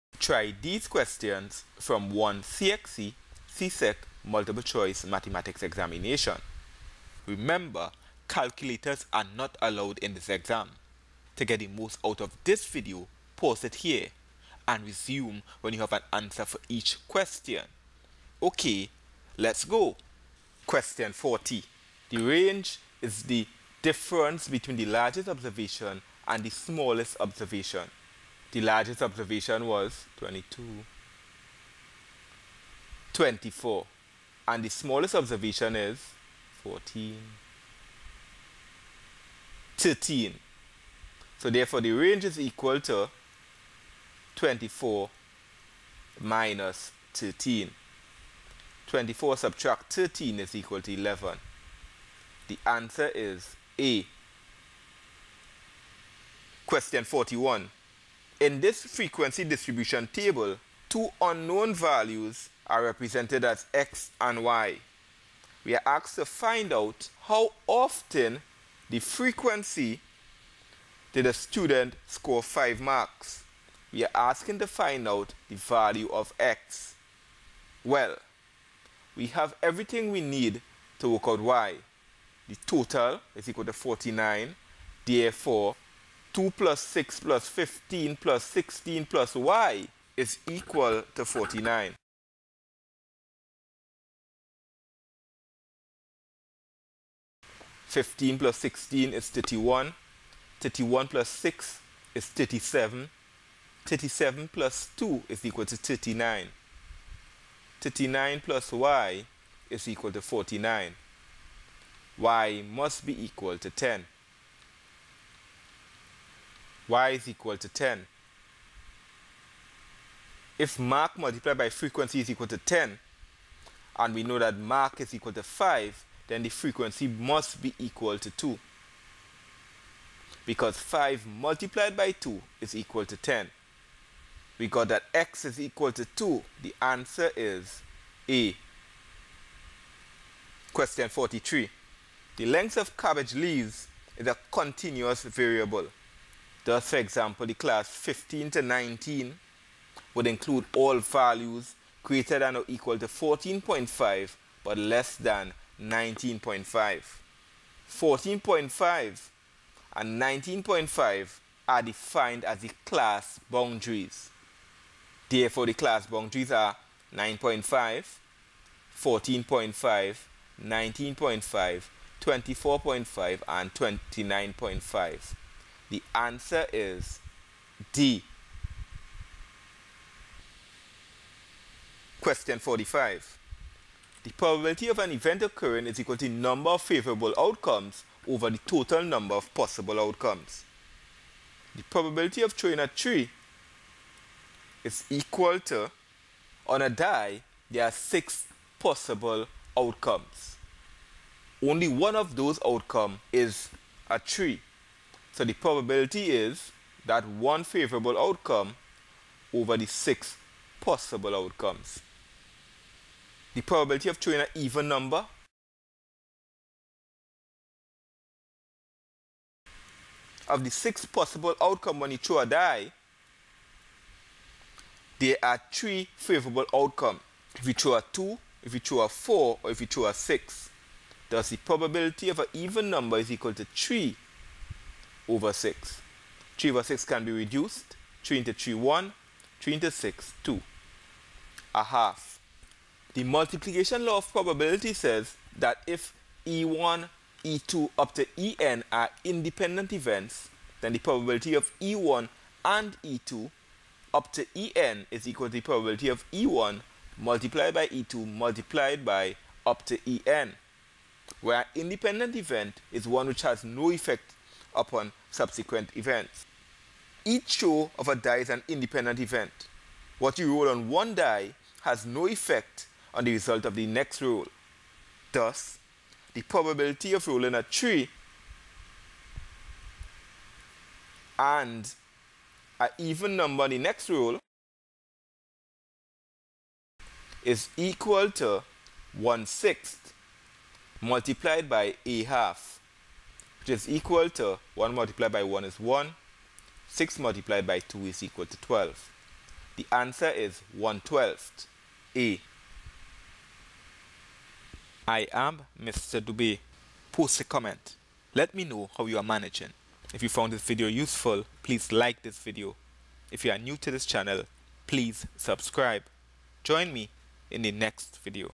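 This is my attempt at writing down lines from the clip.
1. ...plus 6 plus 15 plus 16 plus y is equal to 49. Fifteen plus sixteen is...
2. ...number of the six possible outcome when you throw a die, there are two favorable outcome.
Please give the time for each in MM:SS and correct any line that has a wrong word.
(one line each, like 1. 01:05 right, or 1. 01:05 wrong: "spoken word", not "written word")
1. 01:26 right
2. 03:34 wrong: "three", not "two".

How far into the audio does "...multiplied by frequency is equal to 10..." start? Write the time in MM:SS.
02:01.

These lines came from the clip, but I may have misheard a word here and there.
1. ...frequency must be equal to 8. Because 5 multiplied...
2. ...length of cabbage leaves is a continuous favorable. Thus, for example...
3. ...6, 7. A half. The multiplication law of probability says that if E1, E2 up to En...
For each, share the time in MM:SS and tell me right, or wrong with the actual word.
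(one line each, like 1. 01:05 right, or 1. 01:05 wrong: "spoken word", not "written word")
1. 02:06 wrong: "2", not "8"
2. 02:22 wrong: "variable", not "favorable"
3. 03:59 wrong: "2", not "7".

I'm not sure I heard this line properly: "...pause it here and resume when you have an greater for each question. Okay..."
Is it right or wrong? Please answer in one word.
wrong.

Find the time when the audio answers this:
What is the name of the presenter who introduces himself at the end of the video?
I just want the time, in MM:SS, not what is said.
05:05.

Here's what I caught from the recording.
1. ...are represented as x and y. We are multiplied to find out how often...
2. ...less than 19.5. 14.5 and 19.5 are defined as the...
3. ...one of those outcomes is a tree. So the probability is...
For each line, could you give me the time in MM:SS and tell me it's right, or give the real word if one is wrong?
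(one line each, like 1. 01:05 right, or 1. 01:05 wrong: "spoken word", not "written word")
1. 01:02 wrong: "asked", not "multiplied"
2. 02:34 right
3. 03:21 right.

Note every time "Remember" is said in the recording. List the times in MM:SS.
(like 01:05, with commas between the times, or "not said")
00:07.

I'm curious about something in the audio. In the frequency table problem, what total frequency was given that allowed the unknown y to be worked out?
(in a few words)
49.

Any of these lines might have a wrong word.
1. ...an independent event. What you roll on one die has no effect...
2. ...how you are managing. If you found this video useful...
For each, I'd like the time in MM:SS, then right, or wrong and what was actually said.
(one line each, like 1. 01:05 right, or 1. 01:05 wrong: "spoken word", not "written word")
1. 04:28 right
2. 05:08 right.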